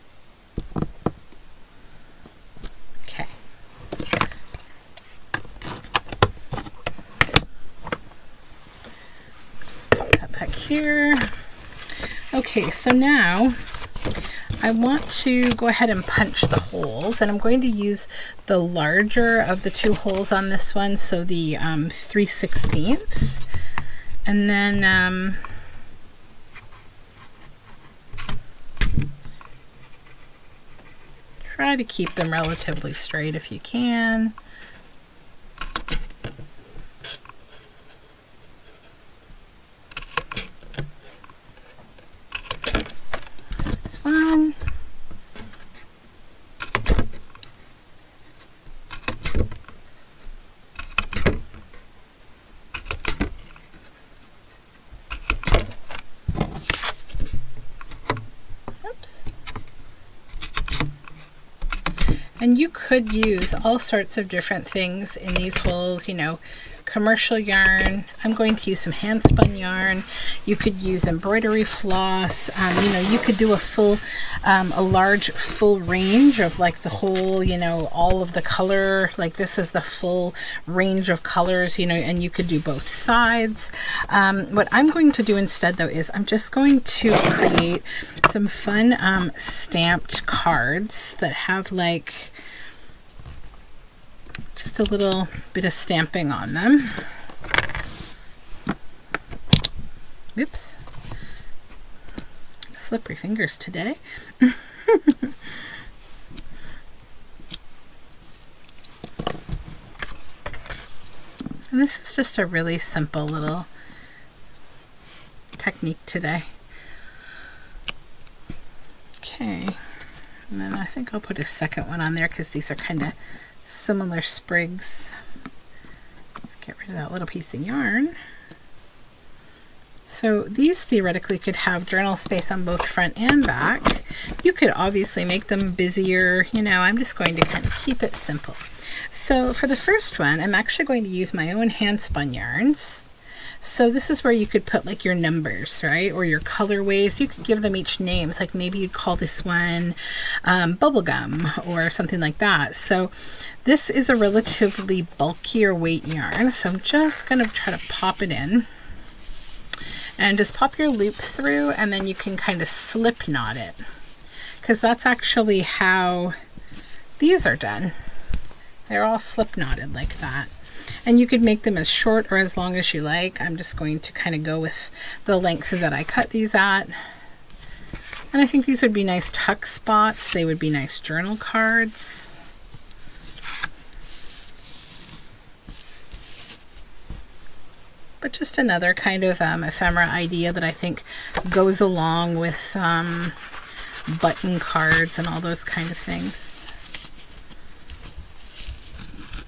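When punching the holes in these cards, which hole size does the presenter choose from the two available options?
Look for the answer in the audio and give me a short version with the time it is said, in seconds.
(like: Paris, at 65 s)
3/16, at 21 s.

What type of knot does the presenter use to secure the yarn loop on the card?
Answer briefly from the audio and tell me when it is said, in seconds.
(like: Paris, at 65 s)
Slip knot, at 162 s.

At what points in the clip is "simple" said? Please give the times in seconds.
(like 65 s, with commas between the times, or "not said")
112 s, 138 s.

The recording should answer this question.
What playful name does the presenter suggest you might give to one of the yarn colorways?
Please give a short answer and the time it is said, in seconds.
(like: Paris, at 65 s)
Bubblegum, at 150 s.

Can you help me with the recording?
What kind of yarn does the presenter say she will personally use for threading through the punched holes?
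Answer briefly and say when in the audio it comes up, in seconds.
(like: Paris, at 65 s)
Hand spun yarn, at 68 s.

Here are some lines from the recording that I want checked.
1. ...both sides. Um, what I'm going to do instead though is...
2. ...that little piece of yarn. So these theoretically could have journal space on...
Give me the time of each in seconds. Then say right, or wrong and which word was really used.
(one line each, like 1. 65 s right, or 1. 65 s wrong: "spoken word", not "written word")
1. 82 s right
2. 126 s right.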